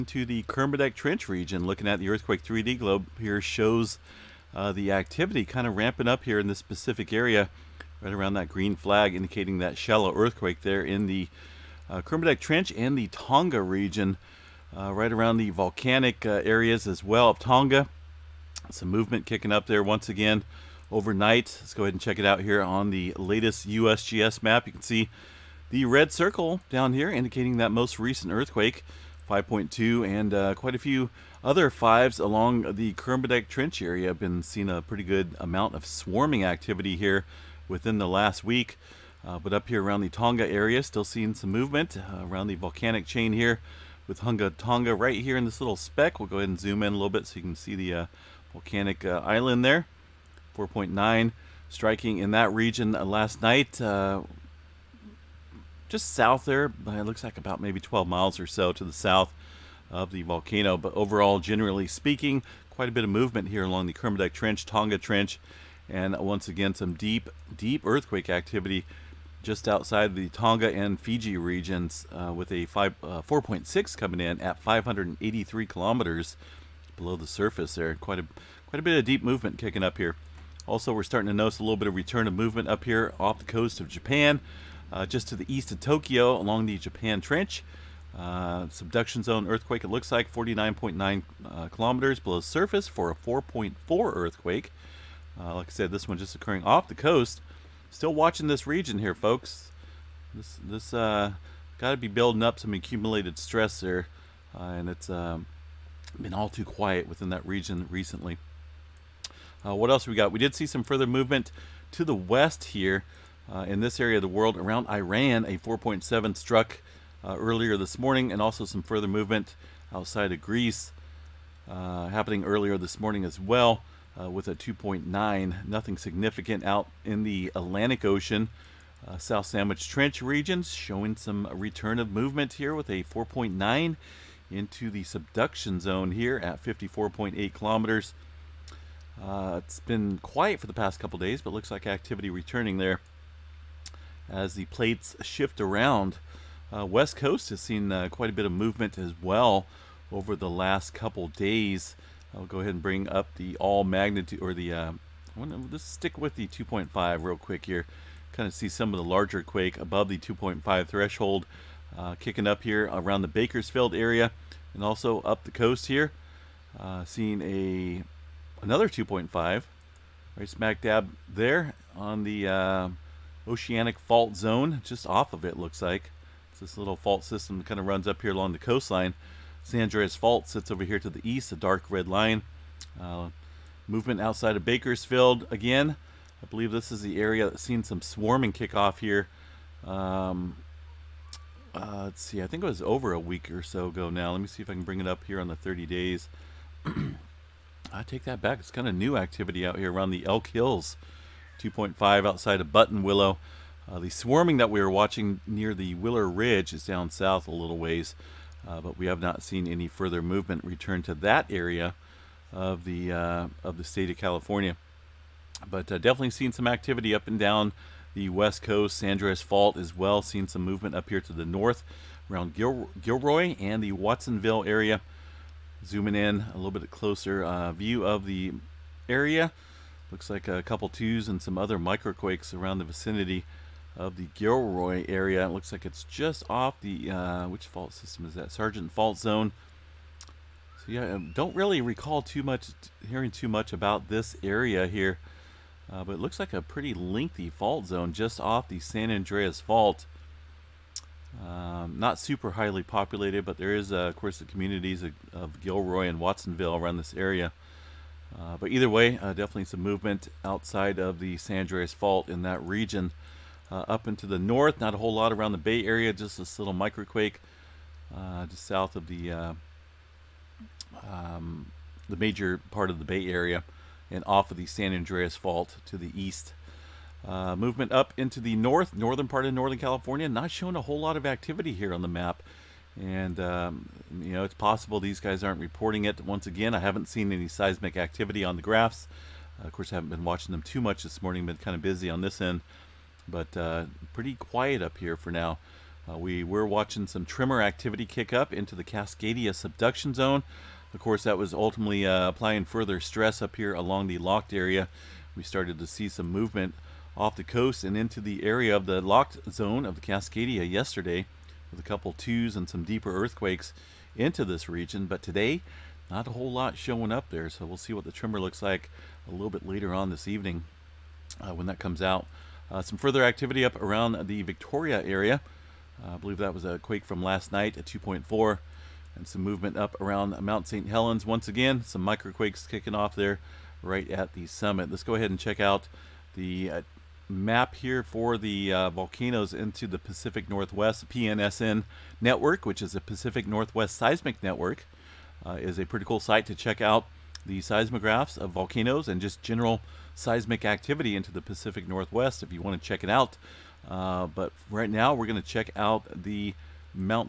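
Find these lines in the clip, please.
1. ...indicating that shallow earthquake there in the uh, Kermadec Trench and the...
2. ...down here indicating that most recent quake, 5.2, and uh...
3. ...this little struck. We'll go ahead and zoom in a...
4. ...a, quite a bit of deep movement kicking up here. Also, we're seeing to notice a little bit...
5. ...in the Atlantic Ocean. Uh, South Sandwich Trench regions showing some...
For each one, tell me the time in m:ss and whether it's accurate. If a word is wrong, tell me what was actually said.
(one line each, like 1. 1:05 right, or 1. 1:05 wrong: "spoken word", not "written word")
1. 0:09 right
2. 0:26 wrong: "earthquake", not "quake"
3. 0:45 wrong: "speck", not "struck"
4. 1:18 wrong: "starting", not "seeing"
5. 2:07 right.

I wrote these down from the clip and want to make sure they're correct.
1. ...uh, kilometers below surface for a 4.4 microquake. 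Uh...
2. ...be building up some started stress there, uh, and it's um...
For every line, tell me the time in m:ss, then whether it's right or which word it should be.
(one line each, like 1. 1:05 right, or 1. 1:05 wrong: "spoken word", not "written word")
1. 1:31 wrong: "earthquake", not "microquake"
2. 1:41 wrong: "accumulated", not "started".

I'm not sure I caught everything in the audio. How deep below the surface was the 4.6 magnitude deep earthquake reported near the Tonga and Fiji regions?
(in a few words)
583 kilometers.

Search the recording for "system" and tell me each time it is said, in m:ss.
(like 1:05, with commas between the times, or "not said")
2:57, 3:57.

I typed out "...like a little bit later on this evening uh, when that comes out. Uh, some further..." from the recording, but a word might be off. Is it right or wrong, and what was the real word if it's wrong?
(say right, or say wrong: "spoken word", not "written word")
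right.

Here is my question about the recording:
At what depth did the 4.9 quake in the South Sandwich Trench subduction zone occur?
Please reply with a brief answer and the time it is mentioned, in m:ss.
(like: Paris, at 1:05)
54.8 kilometers, at 2:16.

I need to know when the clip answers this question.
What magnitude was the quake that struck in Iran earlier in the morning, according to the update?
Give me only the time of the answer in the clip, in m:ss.
1:55.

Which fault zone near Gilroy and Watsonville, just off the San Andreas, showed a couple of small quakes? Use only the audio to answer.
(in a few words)
Sargent Fault Zone.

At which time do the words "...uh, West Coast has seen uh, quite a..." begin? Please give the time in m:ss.
2:26.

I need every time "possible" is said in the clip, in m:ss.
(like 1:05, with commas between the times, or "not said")
4:44.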